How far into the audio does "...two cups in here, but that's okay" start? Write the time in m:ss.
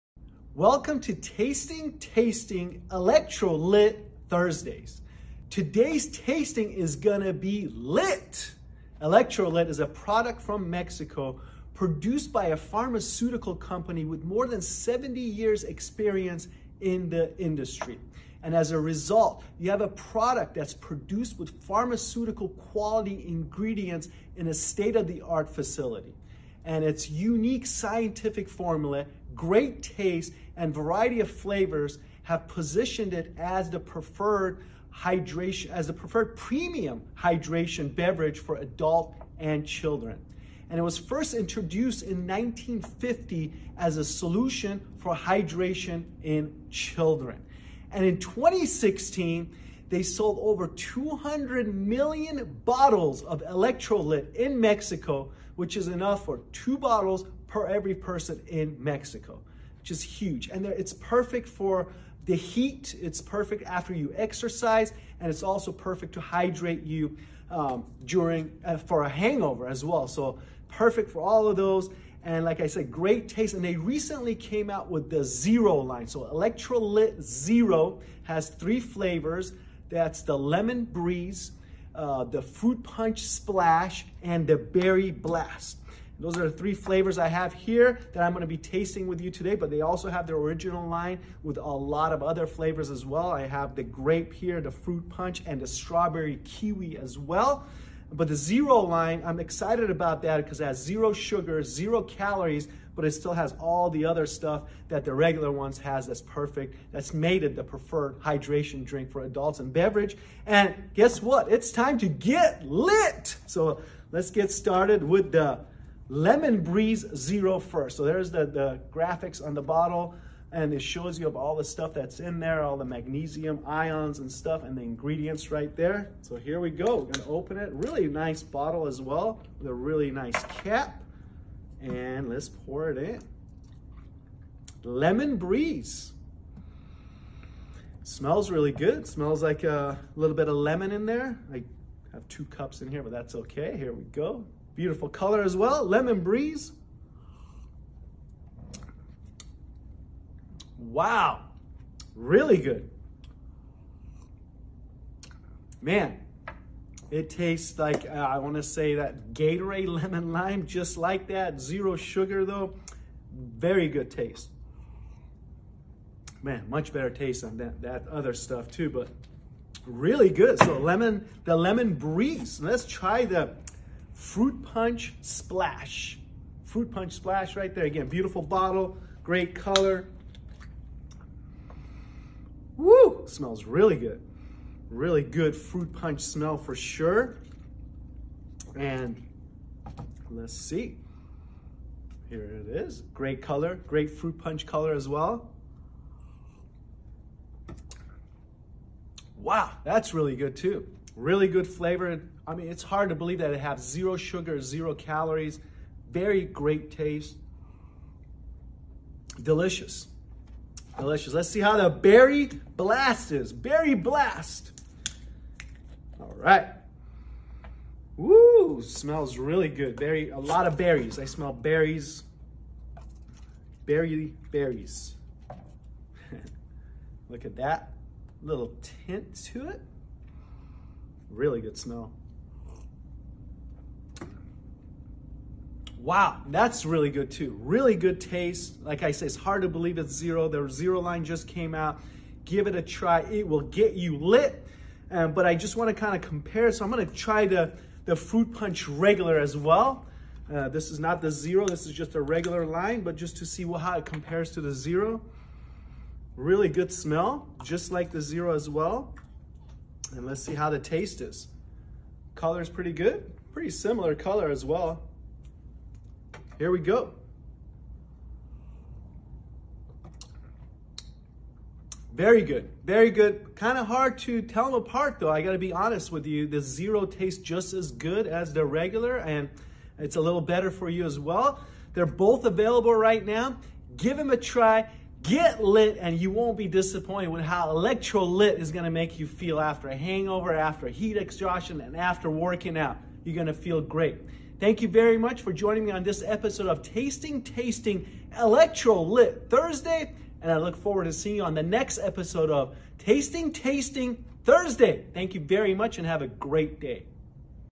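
2:22.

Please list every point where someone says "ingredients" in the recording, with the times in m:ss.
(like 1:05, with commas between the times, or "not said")
0:23, 2:04.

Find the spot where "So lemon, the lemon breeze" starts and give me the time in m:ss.
2:50.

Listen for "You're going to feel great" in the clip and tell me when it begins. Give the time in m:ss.
4:53.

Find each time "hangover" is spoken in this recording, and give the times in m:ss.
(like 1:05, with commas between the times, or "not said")
1:09, 4:49.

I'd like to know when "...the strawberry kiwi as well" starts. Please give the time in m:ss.
1:35.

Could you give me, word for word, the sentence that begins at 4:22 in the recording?
Color is pretty good, pretty similar color as well.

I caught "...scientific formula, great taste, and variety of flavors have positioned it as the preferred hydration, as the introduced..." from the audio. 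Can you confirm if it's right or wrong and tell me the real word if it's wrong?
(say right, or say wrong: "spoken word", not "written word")
wrong: "preferred", not "introduced".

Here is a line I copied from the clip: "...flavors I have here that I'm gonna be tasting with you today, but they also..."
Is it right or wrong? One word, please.
right.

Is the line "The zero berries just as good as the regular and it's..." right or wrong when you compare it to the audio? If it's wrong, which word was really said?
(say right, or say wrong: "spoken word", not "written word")
wrong: "tastes", not "berries".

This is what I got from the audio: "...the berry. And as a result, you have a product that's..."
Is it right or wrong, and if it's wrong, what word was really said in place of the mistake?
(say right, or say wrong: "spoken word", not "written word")
wrong: "industry", not "berry".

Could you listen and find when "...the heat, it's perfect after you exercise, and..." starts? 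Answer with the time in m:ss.
1:02.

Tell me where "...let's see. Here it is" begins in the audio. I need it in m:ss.
3:10.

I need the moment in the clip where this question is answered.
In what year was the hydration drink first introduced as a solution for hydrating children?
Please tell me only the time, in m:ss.
0:42.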